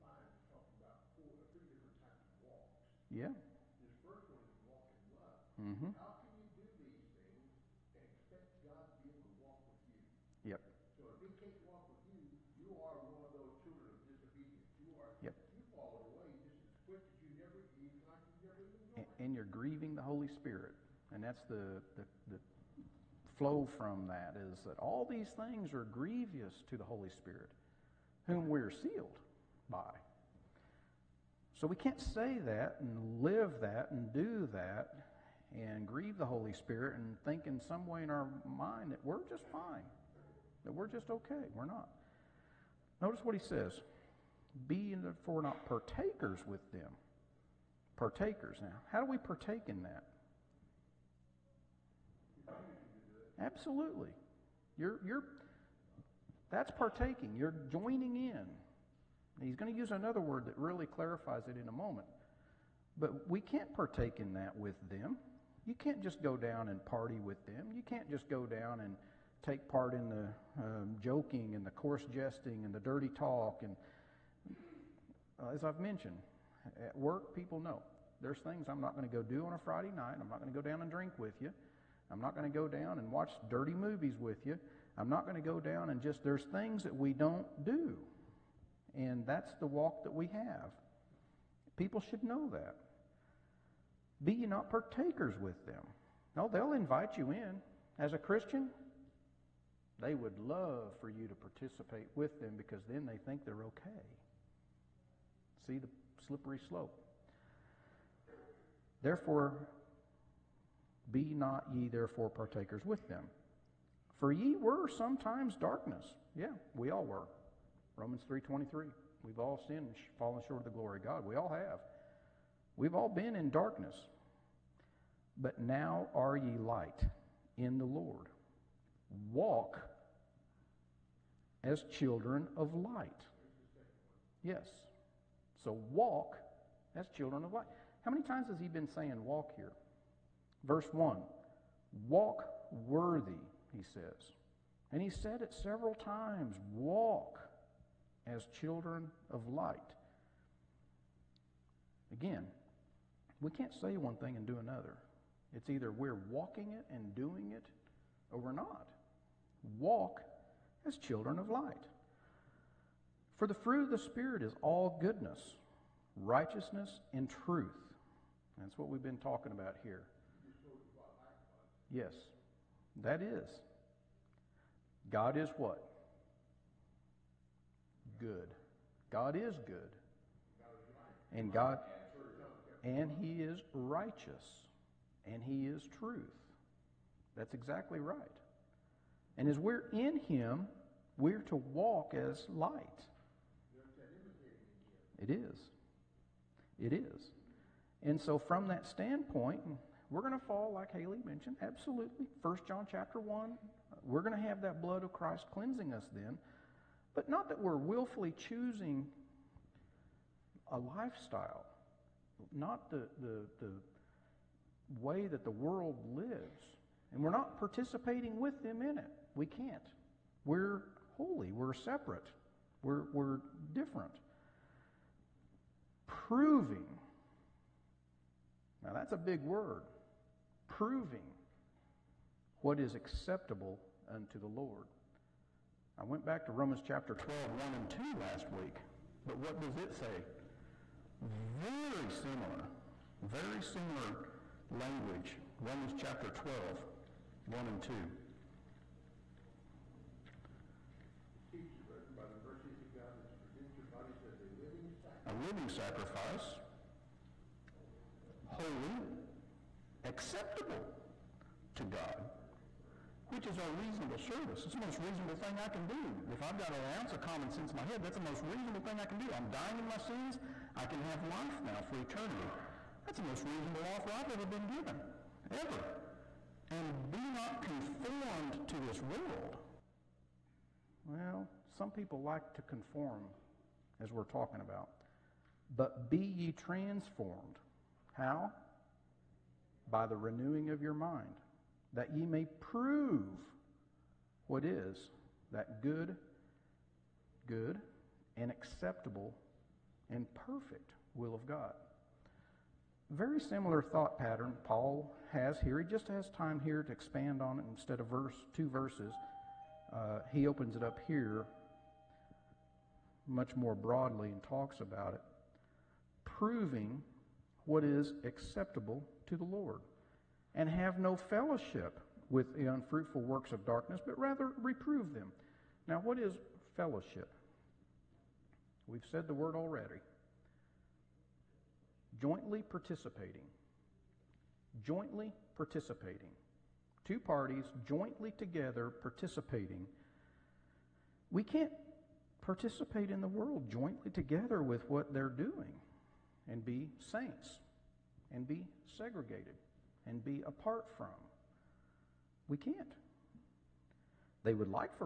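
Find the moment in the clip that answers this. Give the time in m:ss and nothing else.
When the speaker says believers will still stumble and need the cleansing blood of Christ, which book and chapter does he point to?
3:22.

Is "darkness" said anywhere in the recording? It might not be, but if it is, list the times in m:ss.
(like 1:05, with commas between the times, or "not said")
1:55, 2:03, 5:23.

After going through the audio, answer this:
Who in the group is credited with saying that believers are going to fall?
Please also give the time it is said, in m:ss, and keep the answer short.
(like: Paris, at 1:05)
Haley, at 3:20.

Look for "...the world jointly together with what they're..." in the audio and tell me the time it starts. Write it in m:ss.
5:43.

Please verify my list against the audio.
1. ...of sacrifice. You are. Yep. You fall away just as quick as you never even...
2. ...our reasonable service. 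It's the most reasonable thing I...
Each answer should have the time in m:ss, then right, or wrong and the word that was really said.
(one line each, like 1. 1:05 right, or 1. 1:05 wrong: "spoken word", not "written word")
1. 0:13 wrong: "disobedience", not "sacrifice"
2. 4:23 right.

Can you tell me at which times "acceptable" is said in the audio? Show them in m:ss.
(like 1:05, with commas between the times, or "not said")
3:52, 4:20, 4:58, 5:18.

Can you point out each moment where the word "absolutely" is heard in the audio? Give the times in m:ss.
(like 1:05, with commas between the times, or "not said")
0:53, 3:21.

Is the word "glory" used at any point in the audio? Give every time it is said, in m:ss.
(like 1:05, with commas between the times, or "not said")
2:00.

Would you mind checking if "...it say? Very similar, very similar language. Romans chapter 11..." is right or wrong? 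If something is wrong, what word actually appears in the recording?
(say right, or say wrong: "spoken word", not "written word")
wrong: "12", not "11".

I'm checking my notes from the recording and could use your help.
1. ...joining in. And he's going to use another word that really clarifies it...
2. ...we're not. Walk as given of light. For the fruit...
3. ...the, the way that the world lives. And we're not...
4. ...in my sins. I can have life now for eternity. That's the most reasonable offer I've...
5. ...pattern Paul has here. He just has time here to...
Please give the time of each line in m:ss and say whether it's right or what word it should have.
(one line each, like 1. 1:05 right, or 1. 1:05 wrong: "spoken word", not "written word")
1. 0:57 right
2. 2:38 wrong: "children", not "given"
3. 3:33 right
4. 4:29 right
5. 5:04 right.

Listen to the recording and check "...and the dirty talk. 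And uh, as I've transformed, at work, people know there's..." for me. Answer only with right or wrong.
wrong.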